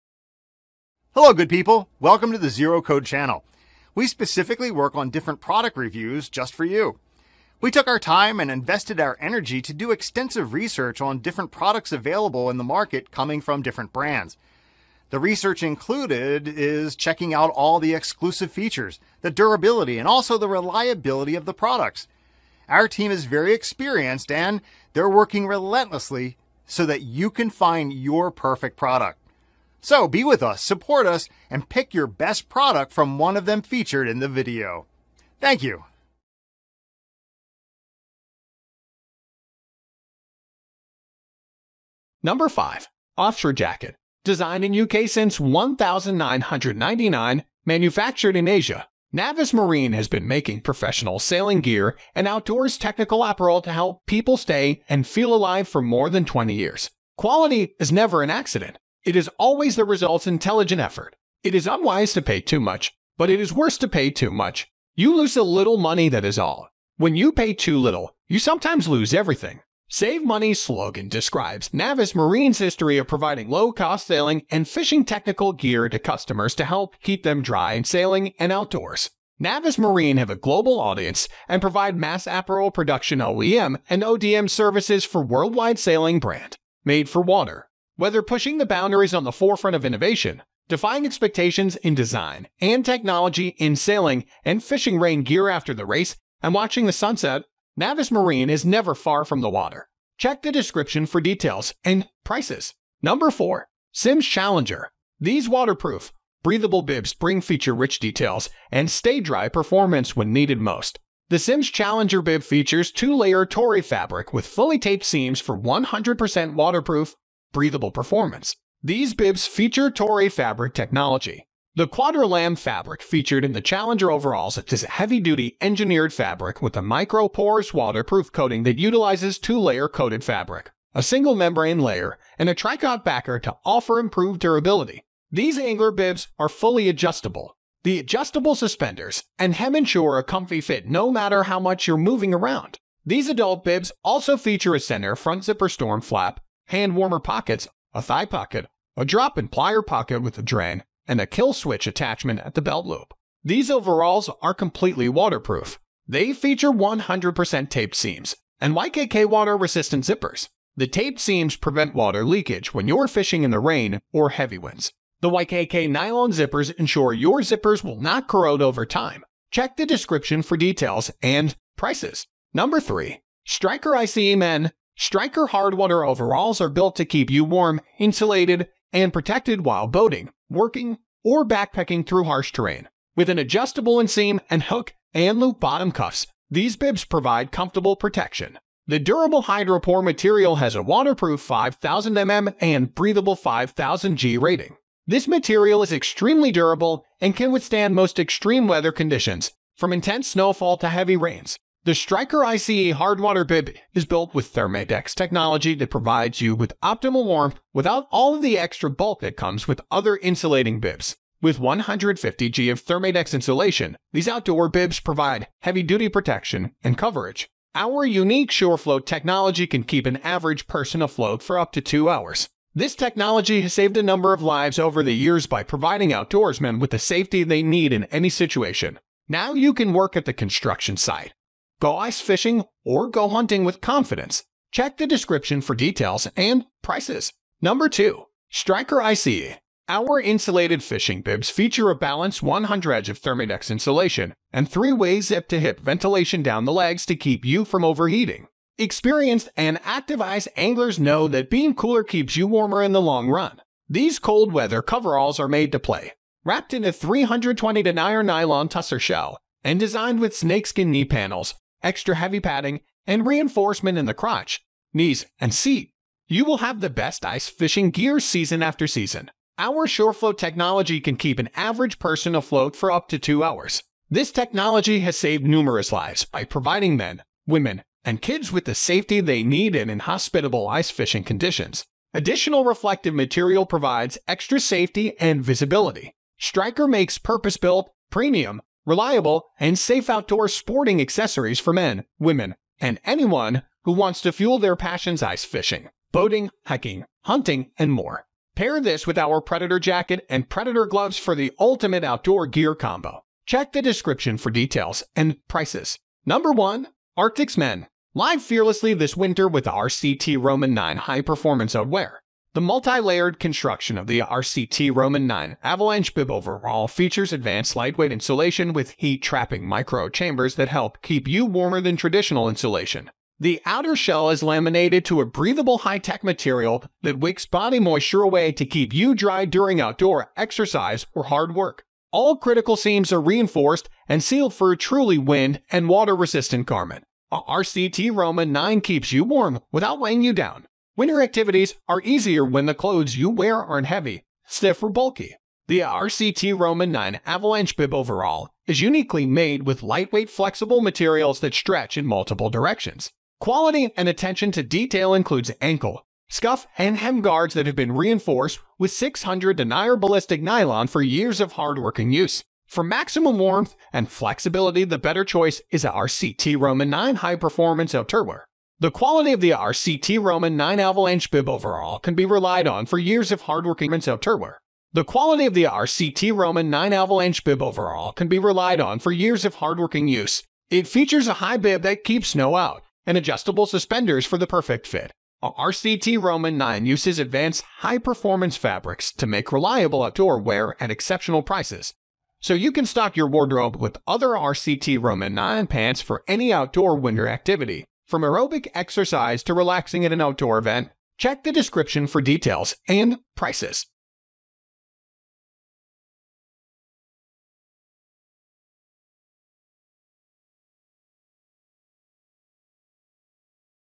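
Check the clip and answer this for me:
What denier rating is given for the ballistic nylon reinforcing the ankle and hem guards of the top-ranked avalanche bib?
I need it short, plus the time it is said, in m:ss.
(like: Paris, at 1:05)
600 denier, at 5:58.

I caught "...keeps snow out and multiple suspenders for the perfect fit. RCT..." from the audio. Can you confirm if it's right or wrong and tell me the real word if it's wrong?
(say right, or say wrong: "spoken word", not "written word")
wrong: "adjustable", not "multiple".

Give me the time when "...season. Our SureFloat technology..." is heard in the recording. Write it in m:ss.
4:28.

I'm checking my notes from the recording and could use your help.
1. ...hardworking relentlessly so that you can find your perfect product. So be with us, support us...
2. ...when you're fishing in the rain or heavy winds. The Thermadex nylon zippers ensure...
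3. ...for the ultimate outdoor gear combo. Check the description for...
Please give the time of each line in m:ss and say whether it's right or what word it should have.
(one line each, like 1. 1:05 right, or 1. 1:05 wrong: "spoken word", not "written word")
1. 0:25 wrong: "working", not "hardworking"
2. 2:42 wrong: "YKK", not "Thermadex"
3. 5:01 right.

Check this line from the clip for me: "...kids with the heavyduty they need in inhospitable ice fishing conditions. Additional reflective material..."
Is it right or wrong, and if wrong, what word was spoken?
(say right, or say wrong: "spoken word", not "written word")
wrong: "safety", not "heavyduty".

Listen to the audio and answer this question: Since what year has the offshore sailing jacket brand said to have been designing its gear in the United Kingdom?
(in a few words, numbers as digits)
1999.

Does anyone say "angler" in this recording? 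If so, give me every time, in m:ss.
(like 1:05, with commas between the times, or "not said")
2:15, 4:10.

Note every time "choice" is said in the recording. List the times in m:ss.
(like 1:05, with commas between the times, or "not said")
6:05.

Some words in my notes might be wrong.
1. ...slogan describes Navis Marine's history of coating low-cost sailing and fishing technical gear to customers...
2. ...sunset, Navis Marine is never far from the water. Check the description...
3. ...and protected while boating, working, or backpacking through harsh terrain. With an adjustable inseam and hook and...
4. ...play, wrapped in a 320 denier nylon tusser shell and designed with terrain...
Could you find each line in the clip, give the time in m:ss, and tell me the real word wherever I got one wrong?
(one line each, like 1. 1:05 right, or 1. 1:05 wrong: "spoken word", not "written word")
1. 1:10 wrong: "providing", not "coating"
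2. 1:36 right
3. 2:58 right
4. 4:15 wrong: "snakeskin", not "terrain".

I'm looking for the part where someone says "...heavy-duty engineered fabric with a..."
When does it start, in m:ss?
2:04.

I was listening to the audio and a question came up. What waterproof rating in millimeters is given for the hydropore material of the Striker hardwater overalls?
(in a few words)
5000 mm.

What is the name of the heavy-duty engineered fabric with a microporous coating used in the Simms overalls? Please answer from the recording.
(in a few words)
Quadrilam.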